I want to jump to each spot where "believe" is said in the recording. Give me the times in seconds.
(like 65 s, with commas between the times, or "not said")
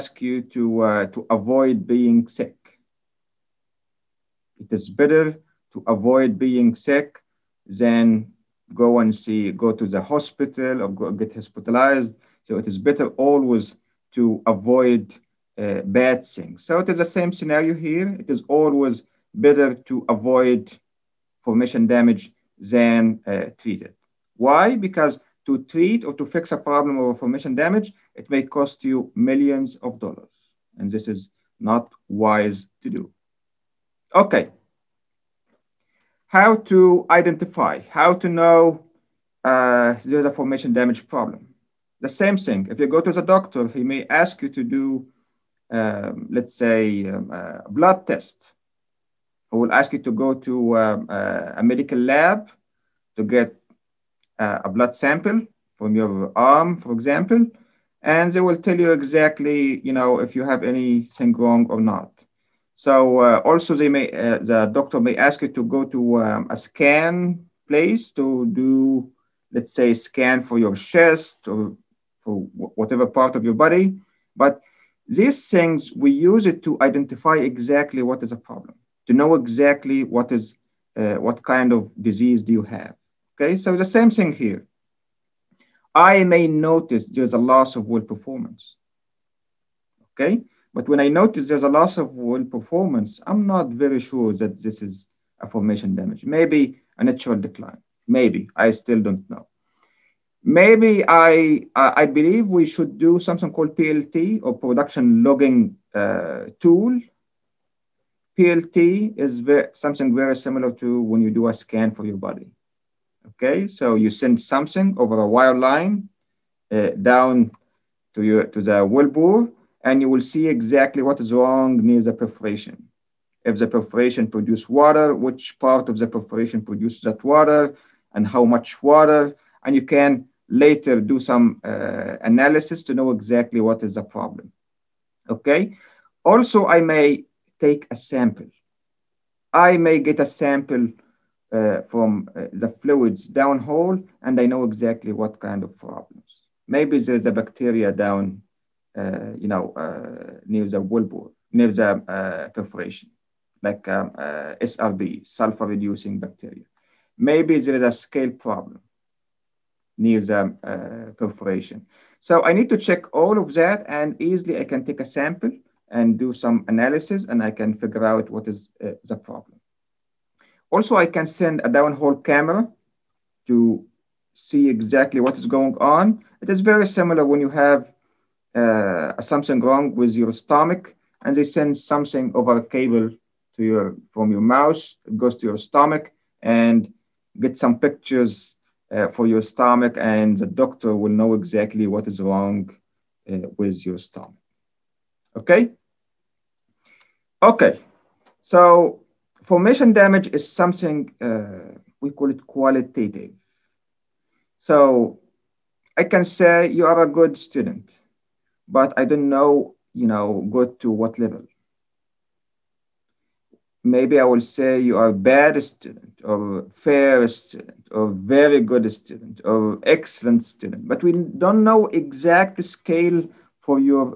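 102 s.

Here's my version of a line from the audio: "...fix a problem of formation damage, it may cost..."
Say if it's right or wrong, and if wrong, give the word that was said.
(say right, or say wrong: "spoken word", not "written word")
right.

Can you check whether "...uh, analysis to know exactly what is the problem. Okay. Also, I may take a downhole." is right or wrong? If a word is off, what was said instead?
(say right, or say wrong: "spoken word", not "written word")
wrong: "sample", not "downhole".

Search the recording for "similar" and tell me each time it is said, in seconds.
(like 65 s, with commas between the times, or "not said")
110 s, 176 s.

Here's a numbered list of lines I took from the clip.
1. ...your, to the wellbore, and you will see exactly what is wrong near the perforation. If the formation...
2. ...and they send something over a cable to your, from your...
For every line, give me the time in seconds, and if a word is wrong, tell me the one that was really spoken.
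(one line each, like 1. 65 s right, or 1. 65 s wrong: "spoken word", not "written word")
1. 118 s wrong: "perforation", not "formation"
2. 181 s right.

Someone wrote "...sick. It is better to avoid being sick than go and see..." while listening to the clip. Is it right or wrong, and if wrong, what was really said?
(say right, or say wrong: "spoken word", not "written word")
right.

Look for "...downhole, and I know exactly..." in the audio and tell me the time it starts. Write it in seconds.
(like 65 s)
143 s.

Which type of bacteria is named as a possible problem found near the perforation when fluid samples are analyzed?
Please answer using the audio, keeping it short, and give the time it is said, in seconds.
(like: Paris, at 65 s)
sulfur-reducing bacteria, at 155 s.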